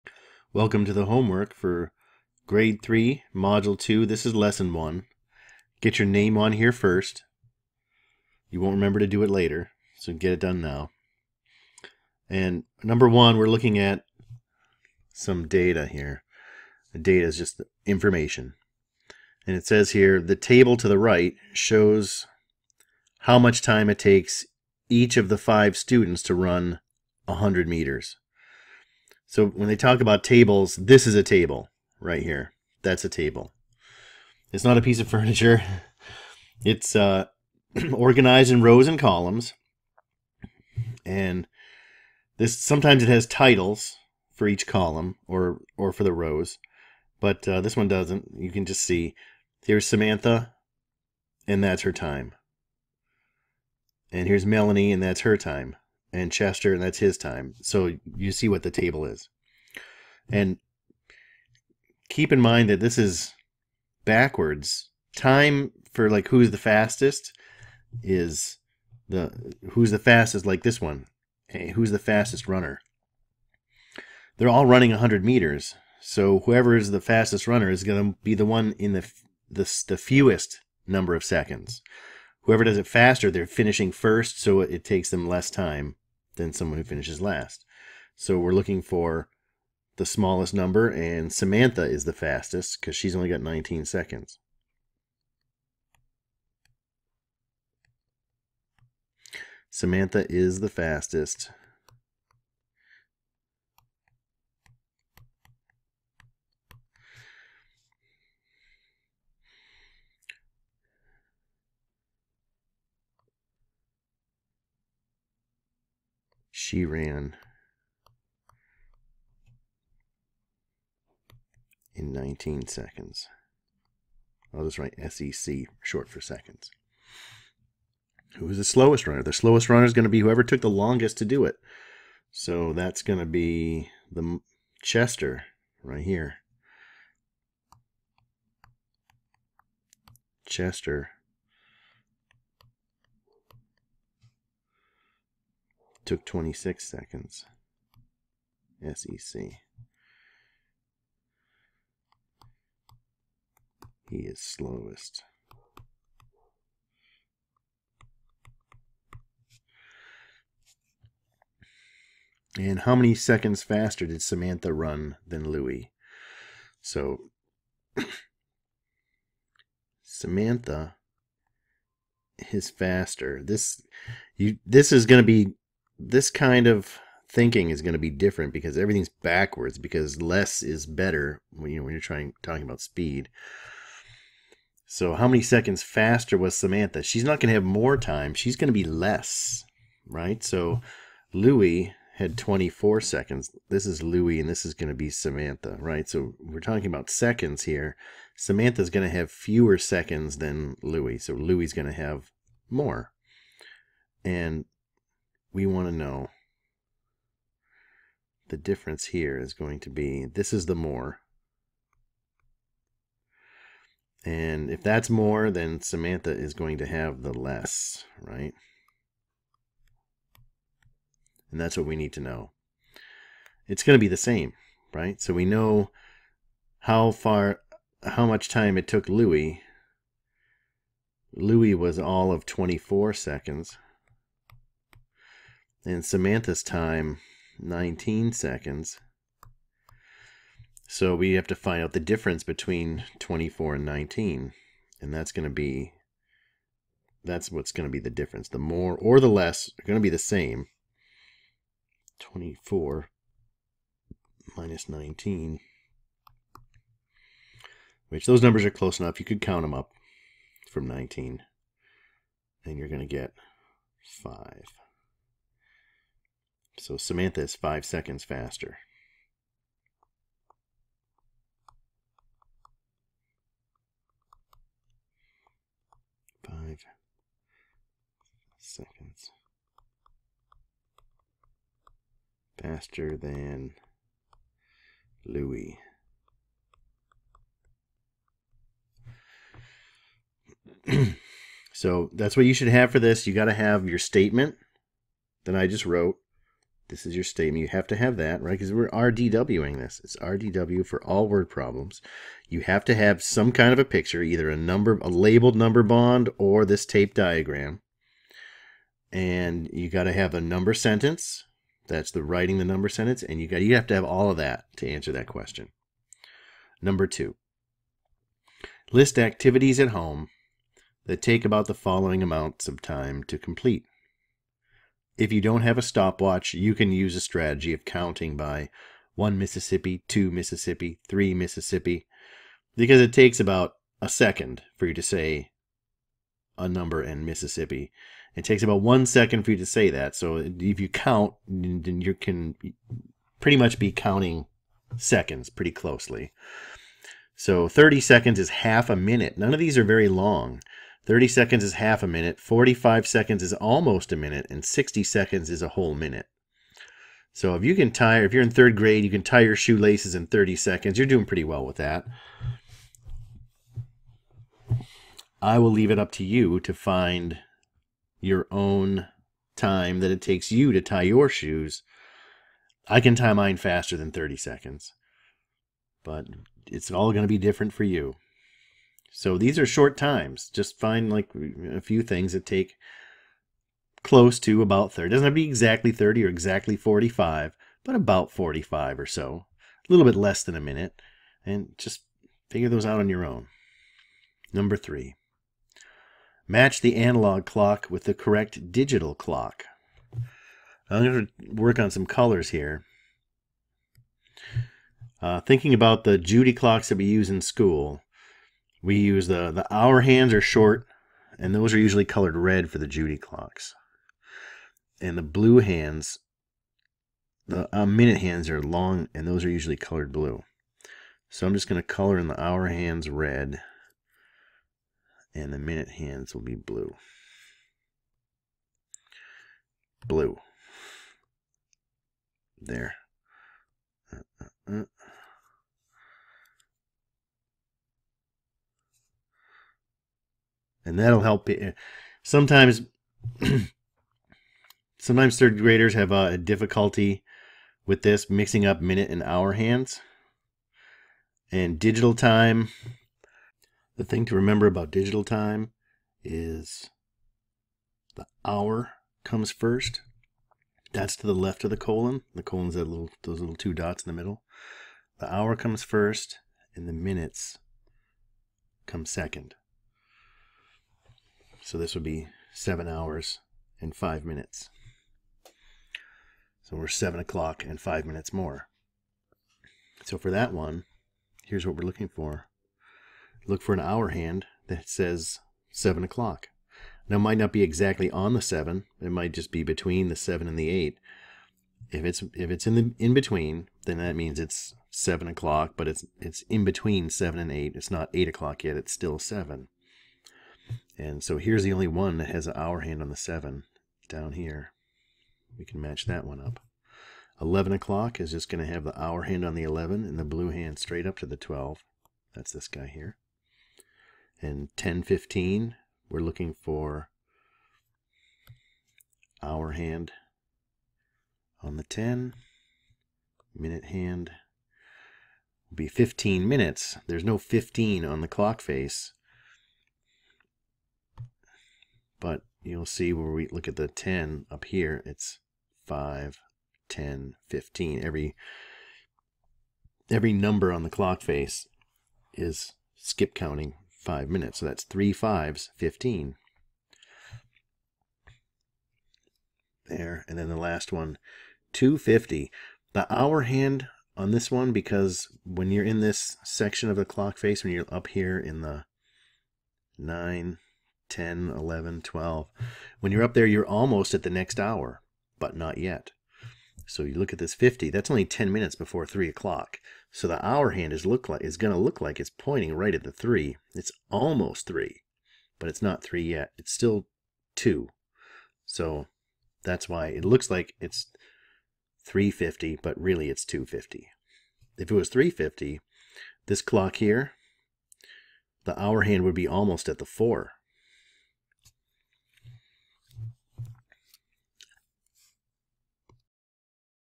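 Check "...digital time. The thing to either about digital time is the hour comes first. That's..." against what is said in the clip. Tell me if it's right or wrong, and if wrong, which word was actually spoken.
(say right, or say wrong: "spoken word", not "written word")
wrong: "remember", not "either".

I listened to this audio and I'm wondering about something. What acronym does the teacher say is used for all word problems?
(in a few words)
RDW.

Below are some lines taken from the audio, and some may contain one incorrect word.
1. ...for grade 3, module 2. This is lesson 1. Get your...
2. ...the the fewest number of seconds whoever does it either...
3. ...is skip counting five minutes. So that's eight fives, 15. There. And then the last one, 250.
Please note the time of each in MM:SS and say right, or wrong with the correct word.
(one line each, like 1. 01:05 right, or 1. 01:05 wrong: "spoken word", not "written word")
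1. 00:01 right
2. 01:19 wrong: "faster", not "either"
3. 09:02 wrong: "three", not "eight".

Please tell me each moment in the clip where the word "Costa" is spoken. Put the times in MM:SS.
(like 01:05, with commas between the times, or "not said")
not said.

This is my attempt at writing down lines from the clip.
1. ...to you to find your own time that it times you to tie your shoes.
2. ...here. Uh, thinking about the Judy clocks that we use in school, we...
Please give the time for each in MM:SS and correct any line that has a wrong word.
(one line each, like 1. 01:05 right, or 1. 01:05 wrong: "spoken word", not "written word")
1. 06:06 wrong: "takes", not "times"
2. 06:42 right.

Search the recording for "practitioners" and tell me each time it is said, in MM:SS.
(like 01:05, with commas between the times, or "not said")
not said.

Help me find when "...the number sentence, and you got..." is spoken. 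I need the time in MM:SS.
05:12.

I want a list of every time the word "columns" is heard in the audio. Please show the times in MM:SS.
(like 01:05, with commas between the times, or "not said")
00:38, 00:44.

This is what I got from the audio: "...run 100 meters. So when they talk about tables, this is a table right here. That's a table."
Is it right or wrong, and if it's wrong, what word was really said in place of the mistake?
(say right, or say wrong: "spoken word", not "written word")
right.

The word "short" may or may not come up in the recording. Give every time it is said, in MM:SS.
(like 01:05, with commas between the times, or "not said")
02:05, 06:19, 06:50.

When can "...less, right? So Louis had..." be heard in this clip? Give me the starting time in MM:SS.
03:08.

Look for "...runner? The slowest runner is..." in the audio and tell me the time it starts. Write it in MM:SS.
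02:09.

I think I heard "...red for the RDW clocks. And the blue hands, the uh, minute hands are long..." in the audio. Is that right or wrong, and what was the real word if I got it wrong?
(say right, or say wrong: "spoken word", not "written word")
wrong: "Judy", not "RDW".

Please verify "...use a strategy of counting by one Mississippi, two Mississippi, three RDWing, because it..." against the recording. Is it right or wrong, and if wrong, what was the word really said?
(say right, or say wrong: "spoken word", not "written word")
wrong: "Mississippi", not "RDWing".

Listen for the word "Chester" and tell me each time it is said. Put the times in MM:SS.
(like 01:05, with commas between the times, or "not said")
00:56, 02:14, 02:20.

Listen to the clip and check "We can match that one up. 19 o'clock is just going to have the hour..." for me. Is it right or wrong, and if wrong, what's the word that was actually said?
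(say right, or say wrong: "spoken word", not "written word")
wrong: "11", not "19".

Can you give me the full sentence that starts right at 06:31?
And just figure those out on your own.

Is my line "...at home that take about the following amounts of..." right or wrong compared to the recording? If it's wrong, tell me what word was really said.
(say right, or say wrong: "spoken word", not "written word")
right.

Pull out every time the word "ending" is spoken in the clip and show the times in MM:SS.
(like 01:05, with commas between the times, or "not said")
not said.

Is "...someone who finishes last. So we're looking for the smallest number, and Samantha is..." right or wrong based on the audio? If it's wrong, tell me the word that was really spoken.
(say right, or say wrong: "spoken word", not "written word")
right.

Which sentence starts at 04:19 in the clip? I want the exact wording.
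You could count them up from 19.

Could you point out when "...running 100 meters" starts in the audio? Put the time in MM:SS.
01:14.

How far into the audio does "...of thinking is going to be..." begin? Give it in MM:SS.
02:56.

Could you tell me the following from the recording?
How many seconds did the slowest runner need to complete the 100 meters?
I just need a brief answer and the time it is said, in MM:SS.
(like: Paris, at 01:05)
26 seconds, at 02:26.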